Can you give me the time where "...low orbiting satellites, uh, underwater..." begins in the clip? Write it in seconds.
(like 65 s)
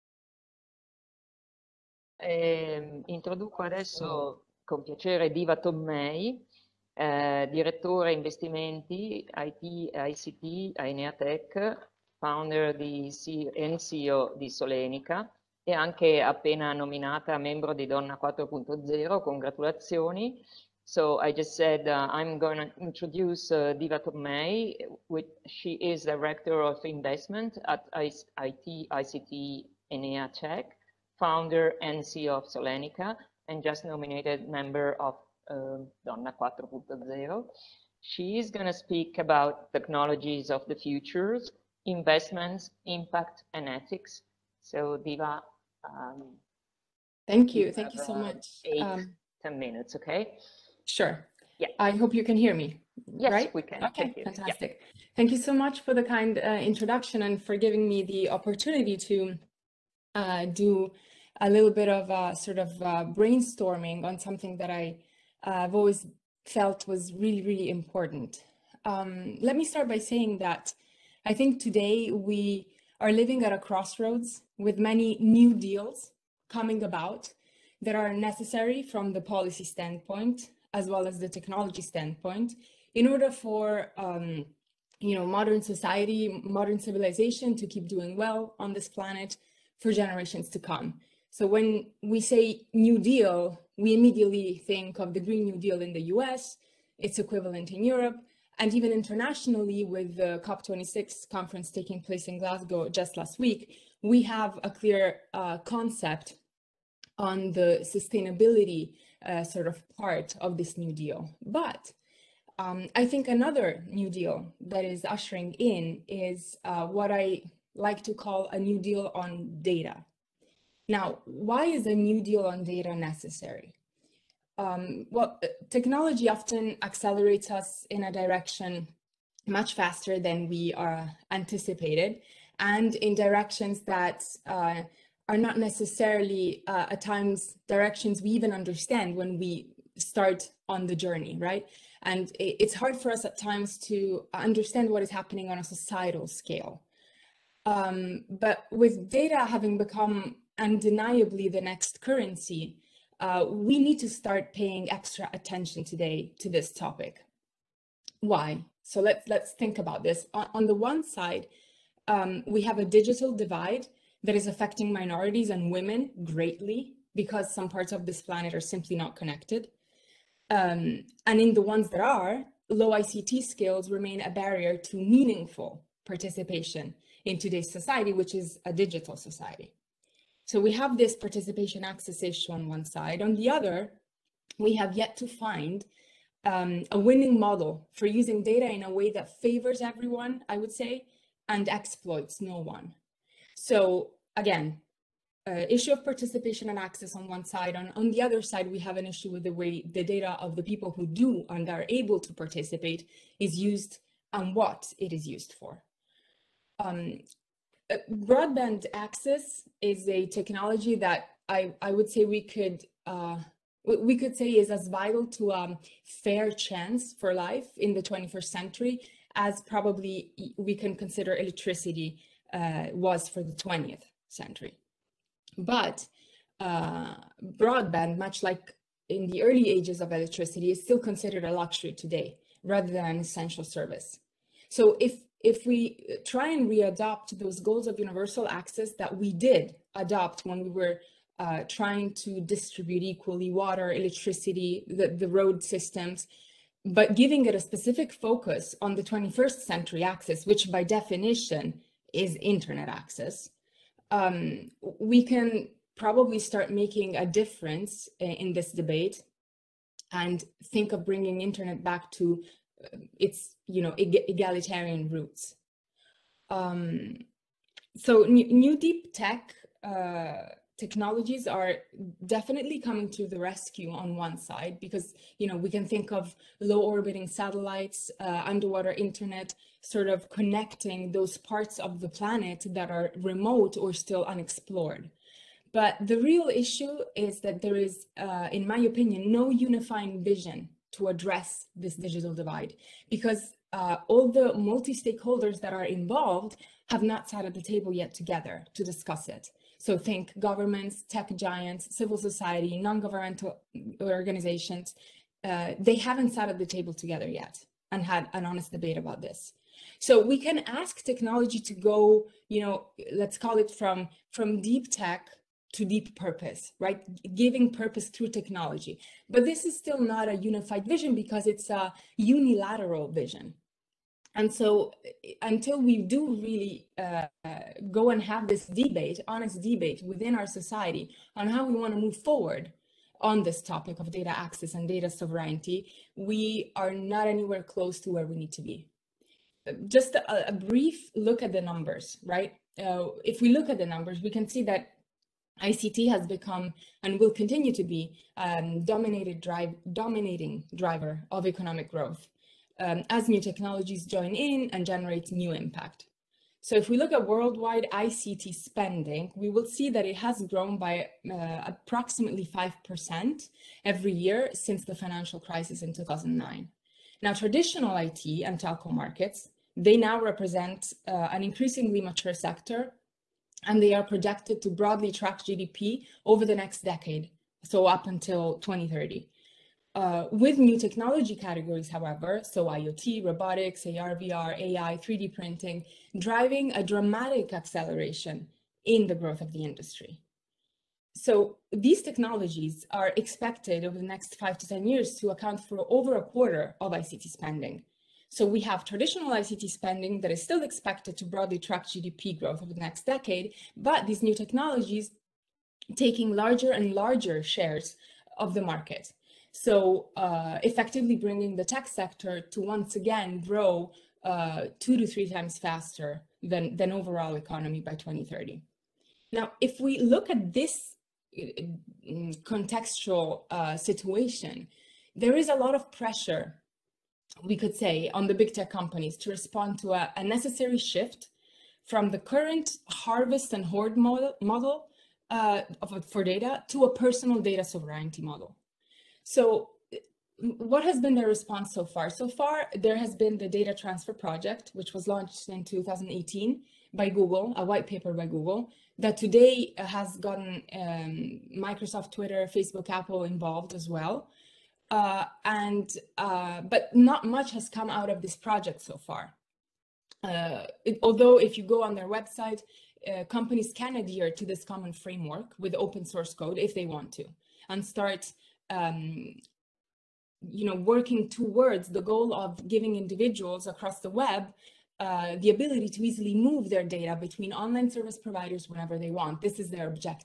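276 s.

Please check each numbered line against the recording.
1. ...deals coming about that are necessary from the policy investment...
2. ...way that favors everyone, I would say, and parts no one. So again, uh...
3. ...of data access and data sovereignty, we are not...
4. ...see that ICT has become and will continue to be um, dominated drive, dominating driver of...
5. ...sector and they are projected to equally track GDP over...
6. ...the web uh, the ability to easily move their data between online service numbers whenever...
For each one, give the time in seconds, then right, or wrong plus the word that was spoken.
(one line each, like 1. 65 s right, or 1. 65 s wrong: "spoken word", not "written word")
1. 75 s wrong: "standpoint", not "investment"
2. 188 s wrong: "exploits", not "parts"
3. 333 s right
4. 344 s right
5. 372 s wrong: "broadly", not "equally"
6. 474 s wrong: "providers", not "numbers".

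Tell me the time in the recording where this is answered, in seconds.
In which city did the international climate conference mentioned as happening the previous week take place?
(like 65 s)
102 s.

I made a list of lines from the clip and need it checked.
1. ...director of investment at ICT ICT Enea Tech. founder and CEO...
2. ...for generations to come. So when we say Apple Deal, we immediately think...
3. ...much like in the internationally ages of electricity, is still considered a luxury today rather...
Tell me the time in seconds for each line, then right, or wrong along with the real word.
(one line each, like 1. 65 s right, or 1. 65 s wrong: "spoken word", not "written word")
1. 26 s right
2. 89 s wrong: "New", not "Apple"
3. 228 s wrong: "early", not "internationally".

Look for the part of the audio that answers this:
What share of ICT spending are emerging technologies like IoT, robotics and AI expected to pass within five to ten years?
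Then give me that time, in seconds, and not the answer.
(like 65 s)
396 s.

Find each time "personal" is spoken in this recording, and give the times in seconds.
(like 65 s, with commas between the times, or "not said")
436 s.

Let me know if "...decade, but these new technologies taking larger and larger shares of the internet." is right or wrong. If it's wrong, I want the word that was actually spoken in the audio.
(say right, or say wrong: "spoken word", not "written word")
wrong: "market", not "internet".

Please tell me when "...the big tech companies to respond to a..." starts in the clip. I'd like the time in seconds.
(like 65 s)
428 s.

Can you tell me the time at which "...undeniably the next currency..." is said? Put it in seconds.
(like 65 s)
150 s.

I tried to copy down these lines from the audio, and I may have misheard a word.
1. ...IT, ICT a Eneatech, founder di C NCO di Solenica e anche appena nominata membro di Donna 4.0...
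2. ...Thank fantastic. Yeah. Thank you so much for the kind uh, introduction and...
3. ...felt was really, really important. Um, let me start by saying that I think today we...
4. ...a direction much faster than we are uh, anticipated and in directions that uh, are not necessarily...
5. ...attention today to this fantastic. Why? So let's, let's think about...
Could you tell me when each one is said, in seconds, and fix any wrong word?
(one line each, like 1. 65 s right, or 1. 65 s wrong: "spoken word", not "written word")
1. 9 s right
2. 54 s right
3. 66 s right
4. 128 s right
5. 155 s wrong: "topic", not "fantastic".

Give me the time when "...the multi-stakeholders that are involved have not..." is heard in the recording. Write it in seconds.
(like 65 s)
294 s.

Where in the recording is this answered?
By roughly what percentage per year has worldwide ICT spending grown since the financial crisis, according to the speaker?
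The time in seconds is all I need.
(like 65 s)
362 s.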